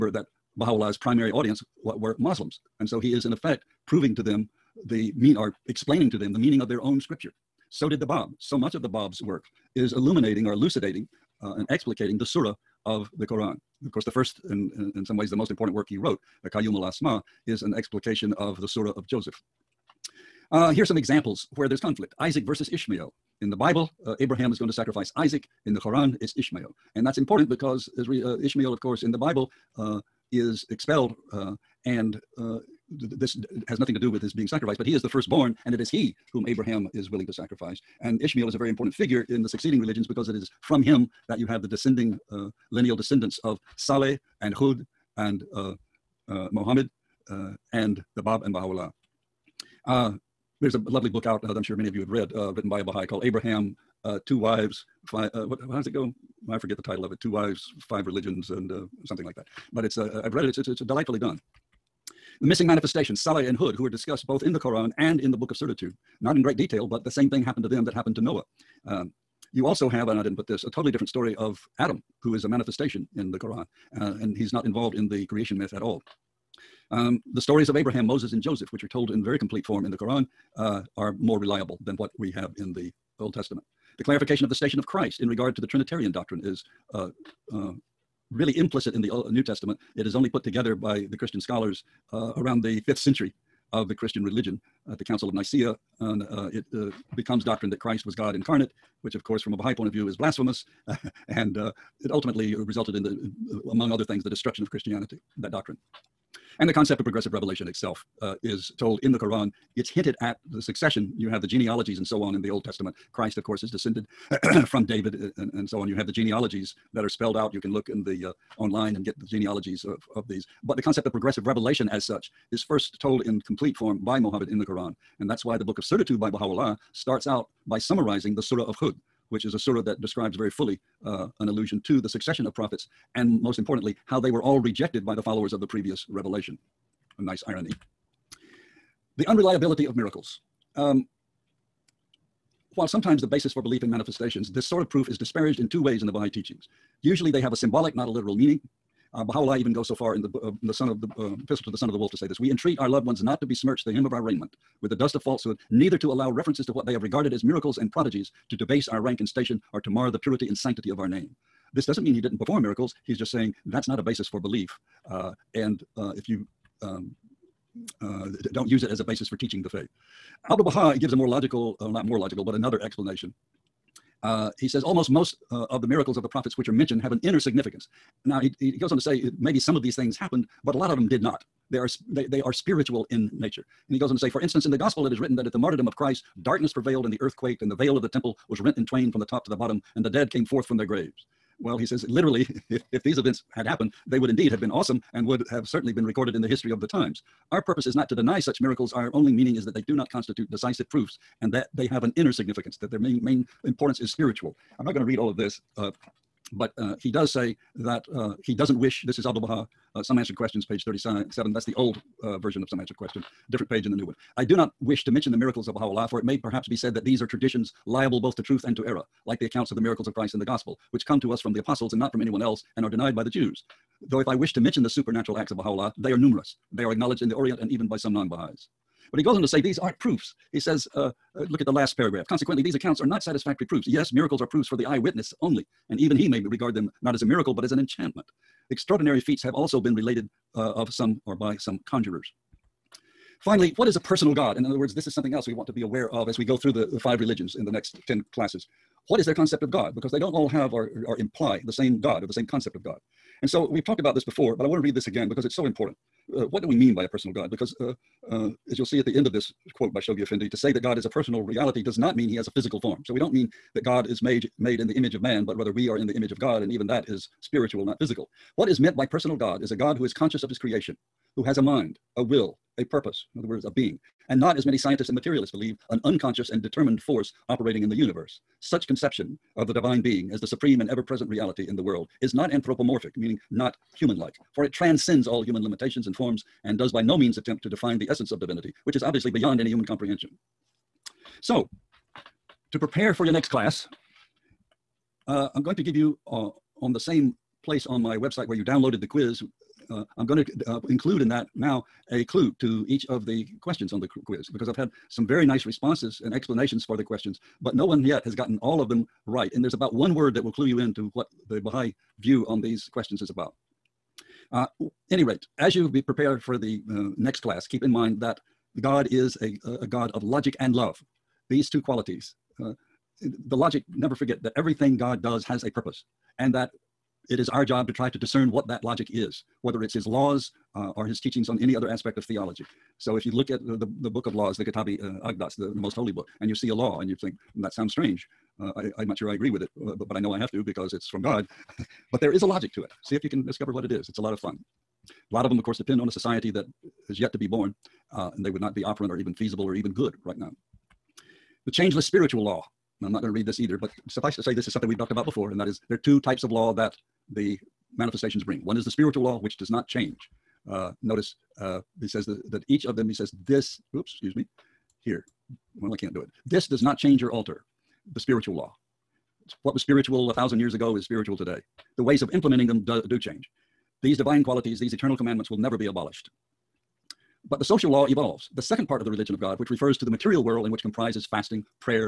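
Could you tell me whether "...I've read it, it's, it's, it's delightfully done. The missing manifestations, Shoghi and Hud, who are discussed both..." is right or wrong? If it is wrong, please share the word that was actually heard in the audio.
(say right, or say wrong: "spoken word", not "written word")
wrong: "Saleh", not "Shoghi".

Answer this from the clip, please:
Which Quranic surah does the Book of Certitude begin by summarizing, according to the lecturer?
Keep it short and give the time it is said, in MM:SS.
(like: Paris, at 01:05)
Surah of Hud, at 02:08.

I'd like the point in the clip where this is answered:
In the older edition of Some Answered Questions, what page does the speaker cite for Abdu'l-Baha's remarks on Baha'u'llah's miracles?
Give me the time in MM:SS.
03:30.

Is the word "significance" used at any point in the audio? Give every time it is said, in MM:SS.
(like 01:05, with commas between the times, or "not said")
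02:57, 03:22.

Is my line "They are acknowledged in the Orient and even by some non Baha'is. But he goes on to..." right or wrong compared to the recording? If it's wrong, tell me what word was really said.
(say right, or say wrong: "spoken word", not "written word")
right.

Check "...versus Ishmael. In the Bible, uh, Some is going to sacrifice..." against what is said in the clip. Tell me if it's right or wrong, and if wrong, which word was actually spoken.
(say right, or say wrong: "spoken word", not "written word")
wrong: "Abraham", not "Some".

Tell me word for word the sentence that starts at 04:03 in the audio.
Finally, what is a personal God?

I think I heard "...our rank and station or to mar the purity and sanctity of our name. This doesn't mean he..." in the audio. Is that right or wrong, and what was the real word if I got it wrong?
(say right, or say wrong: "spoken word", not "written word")
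right.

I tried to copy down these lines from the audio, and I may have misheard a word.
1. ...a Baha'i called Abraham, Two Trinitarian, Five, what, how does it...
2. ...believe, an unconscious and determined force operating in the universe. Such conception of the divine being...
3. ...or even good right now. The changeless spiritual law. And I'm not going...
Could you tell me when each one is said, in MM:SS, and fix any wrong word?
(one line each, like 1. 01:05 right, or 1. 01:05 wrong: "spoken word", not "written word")
1. 00:52 wrong: "Wives", not "Trinitarian"
2. 04:35 right
3. 05:49 right.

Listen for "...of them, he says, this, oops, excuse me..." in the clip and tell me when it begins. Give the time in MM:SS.
06:02.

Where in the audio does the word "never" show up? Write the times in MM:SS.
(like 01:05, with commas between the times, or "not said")
05:23, 06:15.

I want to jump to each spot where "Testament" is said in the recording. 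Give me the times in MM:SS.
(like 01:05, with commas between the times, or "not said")
01:23, 01:29, 01:52.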